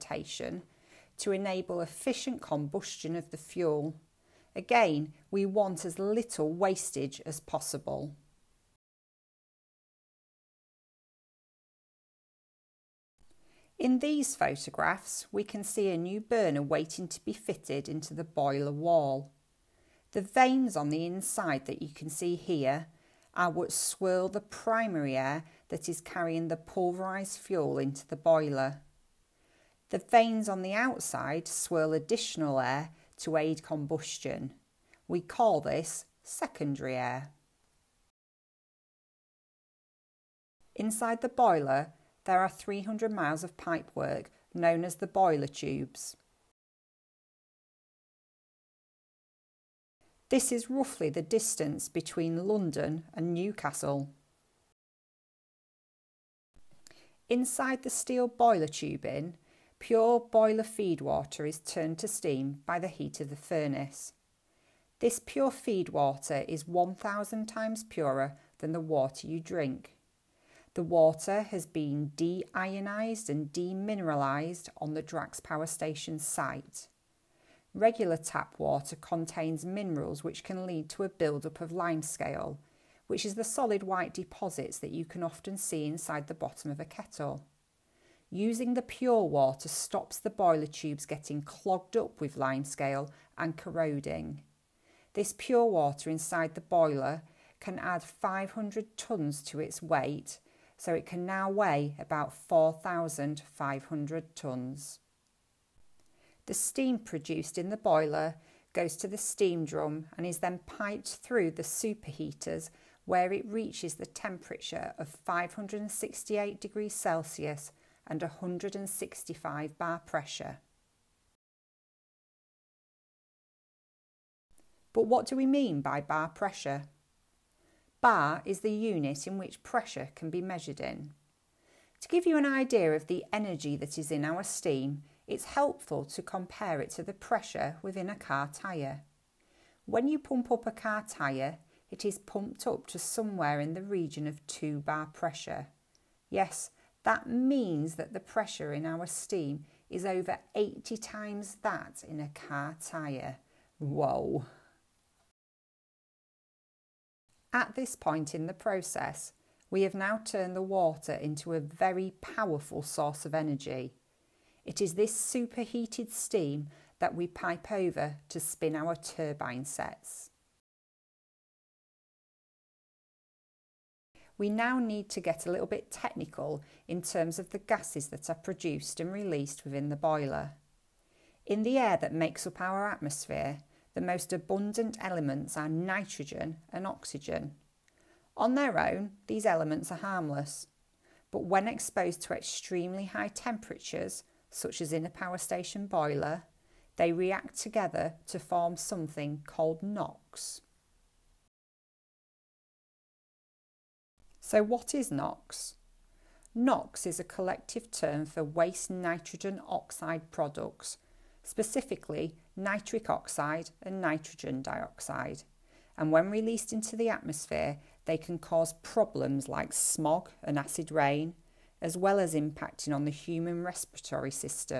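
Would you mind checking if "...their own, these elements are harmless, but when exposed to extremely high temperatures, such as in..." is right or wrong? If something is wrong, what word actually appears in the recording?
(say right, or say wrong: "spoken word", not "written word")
right.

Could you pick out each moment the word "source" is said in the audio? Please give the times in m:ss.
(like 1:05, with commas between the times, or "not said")
2:42.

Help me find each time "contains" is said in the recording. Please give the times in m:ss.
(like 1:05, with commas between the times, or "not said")
1:18.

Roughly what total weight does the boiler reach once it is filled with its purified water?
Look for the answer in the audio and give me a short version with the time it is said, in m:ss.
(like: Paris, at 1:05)
4,500 tonnes, at 1:42.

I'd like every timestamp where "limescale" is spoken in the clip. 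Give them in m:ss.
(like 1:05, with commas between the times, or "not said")
1:21, 1:32.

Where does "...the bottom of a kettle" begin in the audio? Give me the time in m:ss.
1:26.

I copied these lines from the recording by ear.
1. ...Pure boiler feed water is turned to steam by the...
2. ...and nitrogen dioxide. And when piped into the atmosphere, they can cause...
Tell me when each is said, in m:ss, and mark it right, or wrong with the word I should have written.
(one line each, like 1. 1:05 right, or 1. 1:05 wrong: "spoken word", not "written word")
1. 0:59 right
2. 3:33 wrong: "released", not "piped".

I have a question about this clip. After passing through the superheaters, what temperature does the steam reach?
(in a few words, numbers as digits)
568 degrees Celsius.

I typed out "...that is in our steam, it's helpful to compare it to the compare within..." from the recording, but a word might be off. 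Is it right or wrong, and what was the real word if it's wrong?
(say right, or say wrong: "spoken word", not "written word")
wrong: "pressure", not "compare".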